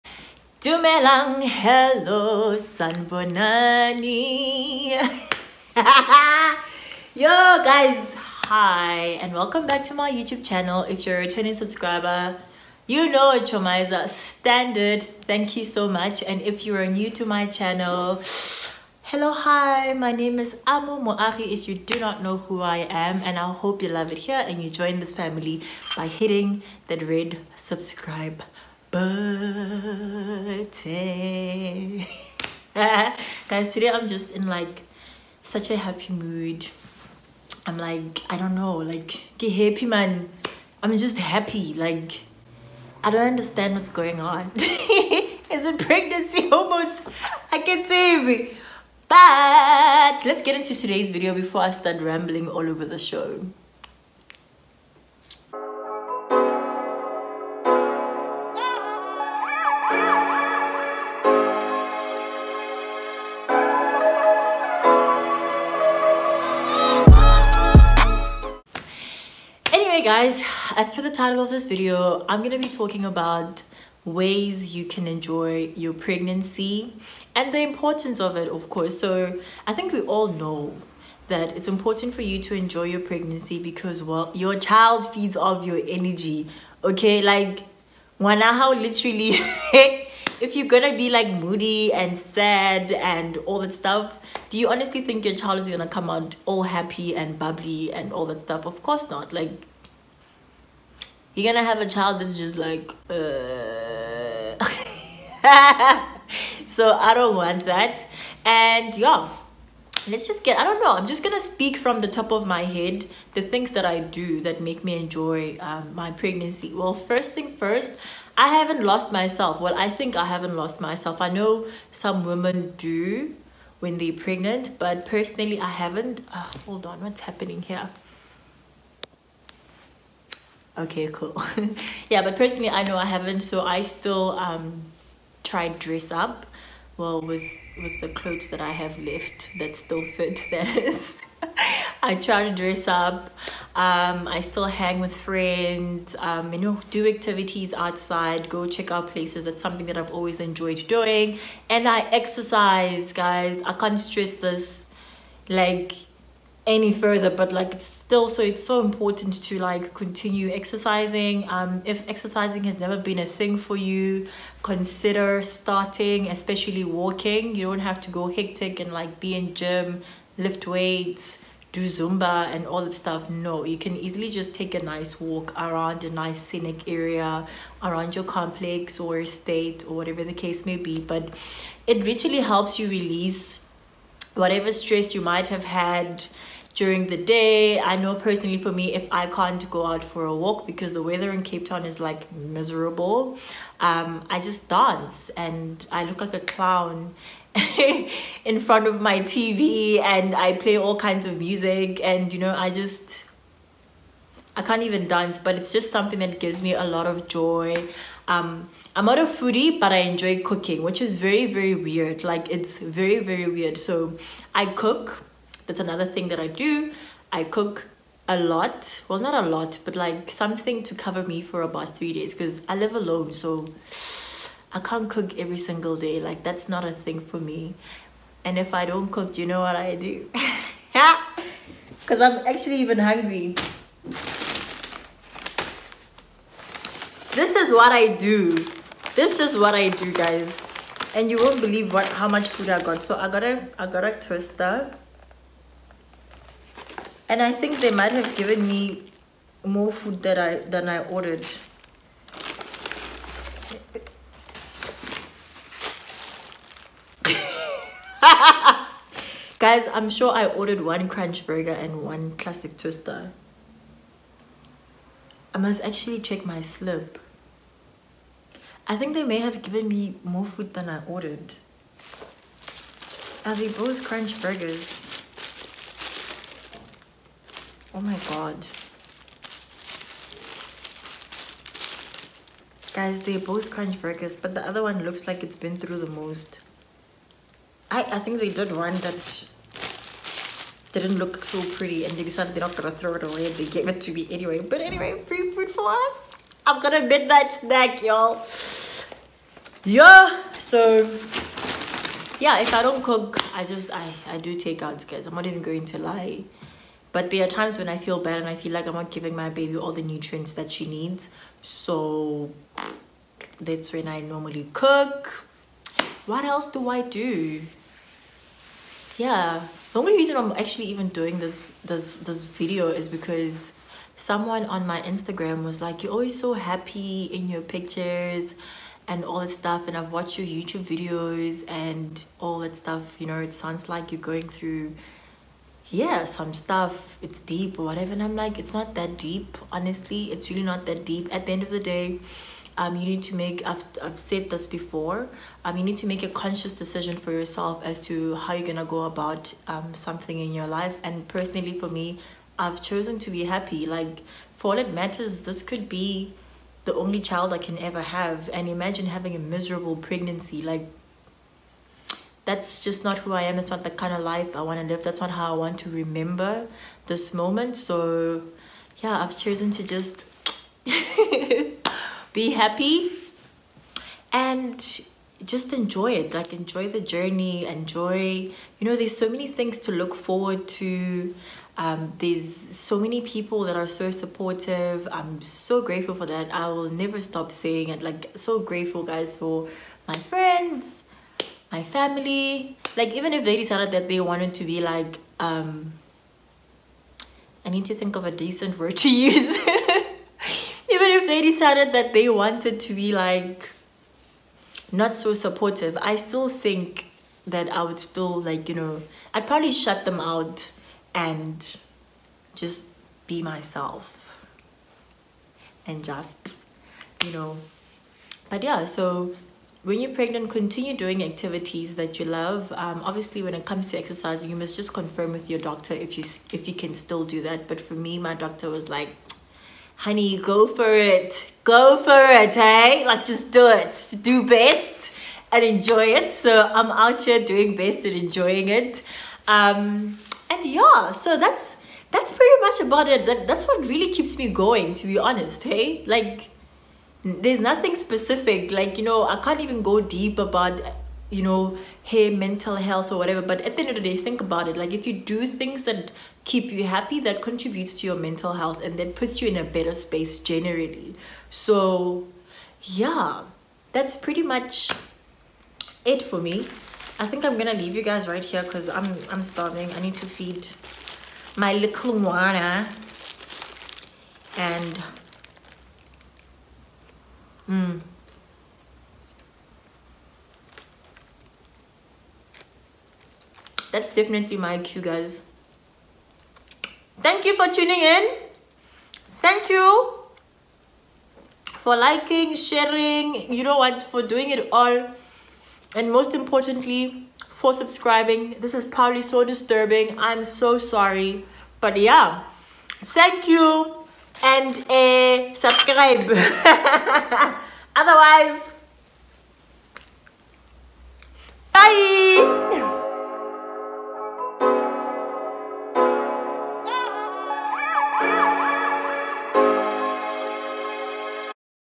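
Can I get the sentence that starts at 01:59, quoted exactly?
Well, I think I haven't lost myself.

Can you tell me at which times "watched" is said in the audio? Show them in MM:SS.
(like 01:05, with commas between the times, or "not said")
05:30.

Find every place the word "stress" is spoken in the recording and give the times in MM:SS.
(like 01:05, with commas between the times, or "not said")
02:33, 03:04.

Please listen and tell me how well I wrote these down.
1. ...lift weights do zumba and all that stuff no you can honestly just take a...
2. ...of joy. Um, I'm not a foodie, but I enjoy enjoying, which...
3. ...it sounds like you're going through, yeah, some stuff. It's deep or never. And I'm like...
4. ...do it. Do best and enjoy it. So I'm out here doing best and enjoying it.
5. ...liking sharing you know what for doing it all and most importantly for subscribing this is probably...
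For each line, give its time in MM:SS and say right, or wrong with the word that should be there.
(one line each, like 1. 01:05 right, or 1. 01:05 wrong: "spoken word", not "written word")
1. 02:50 wrong: "easily", not "honestly"
2. 03:27 wrong: "cooking", not "enjoying"
3. 05:33 wrong: "whatever", not "never"
4. 07:13 right
5. 08:11 right.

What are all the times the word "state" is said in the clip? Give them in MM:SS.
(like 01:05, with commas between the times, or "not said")
02:59.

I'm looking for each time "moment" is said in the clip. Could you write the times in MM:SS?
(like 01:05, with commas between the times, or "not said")
06:07.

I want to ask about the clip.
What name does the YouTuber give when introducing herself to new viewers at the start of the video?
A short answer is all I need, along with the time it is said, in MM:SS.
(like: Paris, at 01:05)
Amo Moagi, at 00:20.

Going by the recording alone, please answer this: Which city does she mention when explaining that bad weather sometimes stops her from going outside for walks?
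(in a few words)
Cape Town.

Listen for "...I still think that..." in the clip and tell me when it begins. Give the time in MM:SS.
06:46.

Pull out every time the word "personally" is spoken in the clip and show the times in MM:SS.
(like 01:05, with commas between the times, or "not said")
02:05, 02:12, 03:08, 05:51.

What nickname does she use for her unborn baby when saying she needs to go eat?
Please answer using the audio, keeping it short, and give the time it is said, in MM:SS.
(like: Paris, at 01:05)
Moana, at 07:52.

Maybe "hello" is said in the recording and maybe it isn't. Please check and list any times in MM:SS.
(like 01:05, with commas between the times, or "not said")
00:01, 00:19.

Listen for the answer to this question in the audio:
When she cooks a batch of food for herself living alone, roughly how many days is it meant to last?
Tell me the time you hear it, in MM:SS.
03:41.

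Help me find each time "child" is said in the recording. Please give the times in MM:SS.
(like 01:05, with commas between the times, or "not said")
01:24, 01:35, 01:41, 05:57.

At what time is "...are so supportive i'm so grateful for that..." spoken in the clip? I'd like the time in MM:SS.
06:23.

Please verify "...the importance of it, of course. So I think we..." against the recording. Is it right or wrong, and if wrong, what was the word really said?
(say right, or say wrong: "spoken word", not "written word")
right.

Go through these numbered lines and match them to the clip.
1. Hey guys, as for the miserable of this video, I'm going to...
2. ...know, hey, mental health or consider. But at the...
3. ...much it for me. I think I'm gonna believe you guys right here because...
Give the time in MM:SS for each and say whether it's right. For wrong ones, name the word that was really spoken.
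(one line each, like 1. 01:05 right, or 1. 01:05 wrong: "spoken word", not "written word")
1. 01:10 wrong: "title", not "miserable"
2. 07:31 wrong: "whatever", not "consider"
3. 07:44 wrong: "leave", not "believe".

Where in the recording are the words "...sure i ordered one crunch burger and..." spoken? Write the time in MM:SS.
04:20.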